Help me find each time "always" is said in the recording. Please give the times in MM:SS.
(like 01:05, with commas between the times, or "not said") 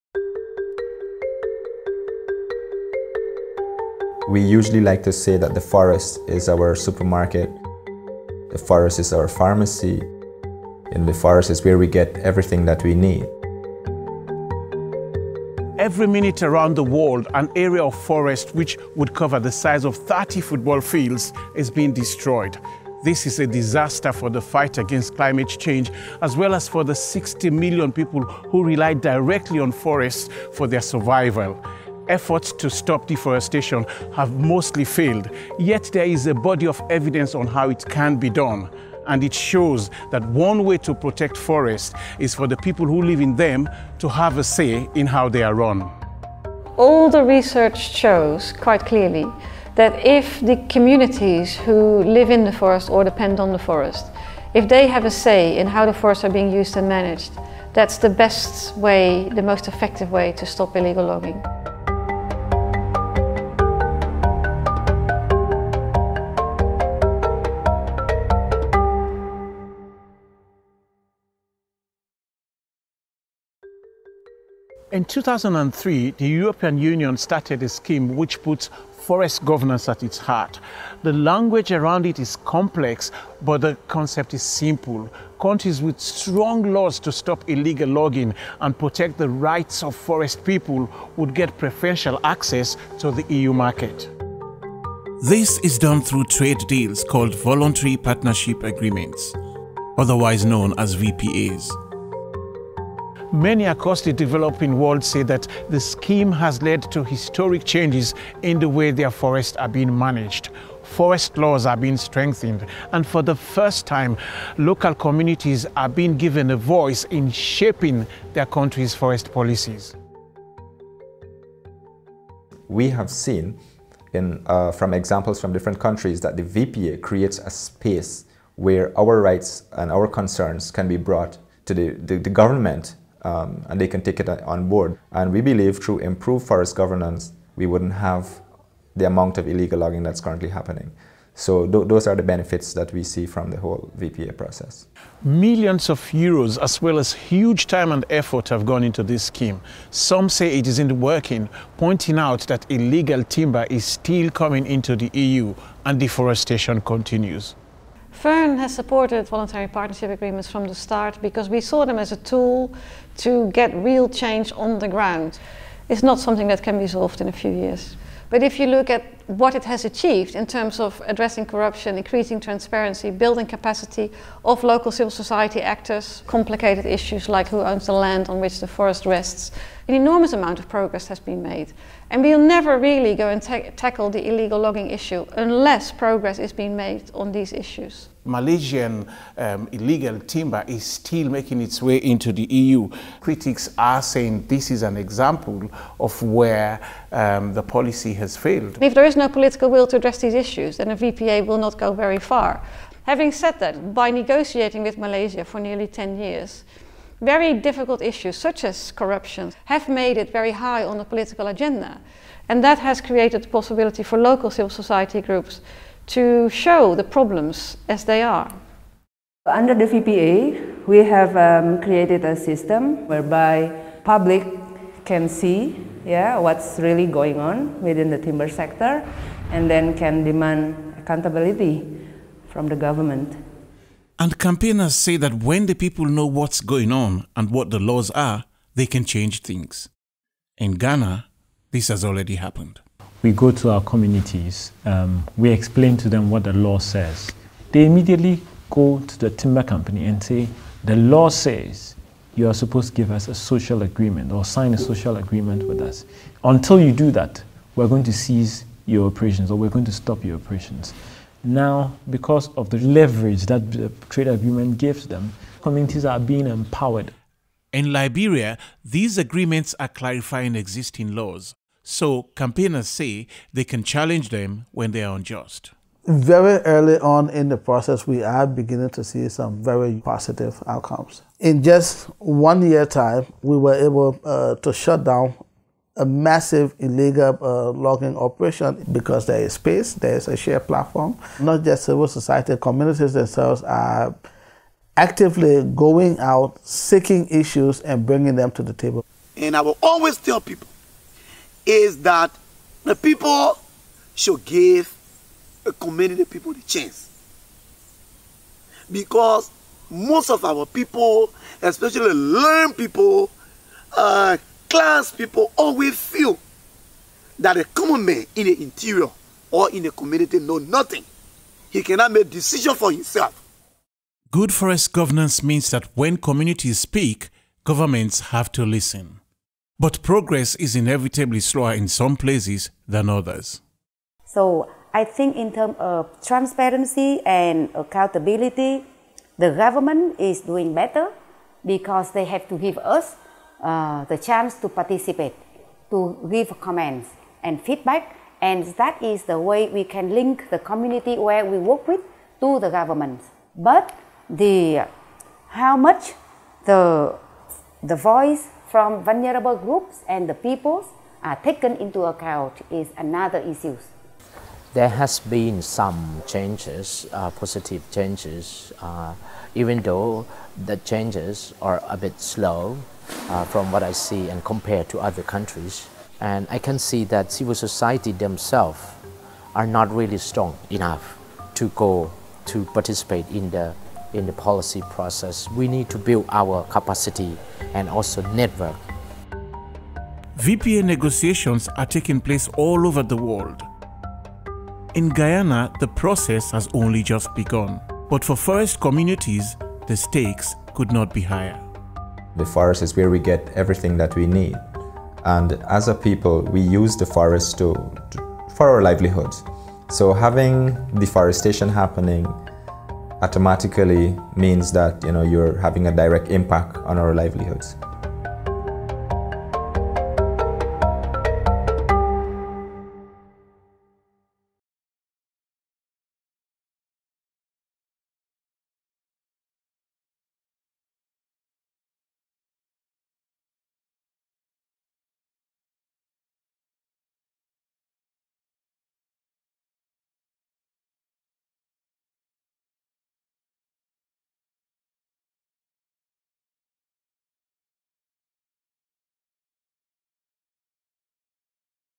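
04:59, 05:15.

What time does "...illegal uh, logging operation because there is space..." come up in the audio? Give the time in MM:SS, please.
04:46.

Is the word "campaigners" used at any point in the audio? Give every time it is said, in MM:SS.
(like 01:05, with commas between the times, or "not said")
03:54, 04:32.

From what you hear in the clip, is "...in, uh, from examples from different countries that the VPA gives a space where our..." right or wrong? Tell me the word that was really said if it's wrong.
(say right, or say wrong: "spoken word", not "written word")
wrong: "creates", not "gives".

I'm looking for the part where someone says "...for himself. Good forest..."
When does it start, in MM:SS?
05:22.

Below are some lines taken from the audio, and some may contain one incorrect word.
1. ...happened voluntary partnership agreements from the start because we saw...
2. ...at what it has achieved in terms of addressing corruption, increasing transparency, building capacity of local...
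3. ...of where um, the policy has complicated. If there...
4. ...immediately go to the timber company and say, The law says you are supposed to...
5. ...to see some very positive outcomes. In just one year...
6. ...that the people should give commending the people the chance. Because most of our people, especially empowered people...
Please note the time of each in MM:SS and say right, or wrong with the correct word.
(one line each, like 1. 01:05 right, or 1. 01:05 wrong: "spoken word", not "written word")
1. 02:38 wrong: "supported", not "happened"
2. 02:48 right
3. 03:15 wrong: "failed", not "complicated"
4. 04:07 right
5. 04:38 right
6. 05:02 wrong: "learned", not "empowered".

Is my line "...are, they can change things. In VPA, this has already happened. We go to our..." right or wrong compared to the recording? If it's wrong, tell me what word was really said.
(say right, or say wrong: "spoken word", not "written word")
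wrong: "Ghana", not "VPA".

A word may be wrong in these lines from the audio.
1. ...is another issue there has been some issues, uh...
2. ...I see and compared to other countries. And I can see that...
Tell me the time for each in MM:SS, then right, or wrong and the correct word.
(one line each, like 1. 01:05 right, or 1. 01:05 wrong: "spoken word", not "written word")
1. 06:02 wrong: "changes", not "issues"
2. 06:13 right.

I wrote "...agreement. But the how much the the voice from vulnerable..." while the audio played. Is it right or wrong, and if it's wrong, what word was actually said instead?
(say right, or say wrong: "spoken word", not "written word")
wrong: "government", not "agreement".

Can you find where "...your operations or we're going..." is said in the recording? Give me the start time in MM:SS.
04:18.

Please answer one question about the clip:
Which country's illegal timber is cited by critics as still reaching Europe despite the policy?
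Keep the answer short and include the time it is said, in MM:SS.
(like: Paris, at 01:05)
Malaysia, at 03:08.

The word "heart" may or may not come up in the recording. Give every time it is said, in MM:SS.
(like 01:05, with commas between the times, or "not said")
01:20.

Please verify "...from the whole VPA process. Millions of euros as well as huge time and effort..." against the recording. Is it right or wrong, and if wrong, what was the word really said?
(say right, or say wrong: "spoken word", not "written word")
right.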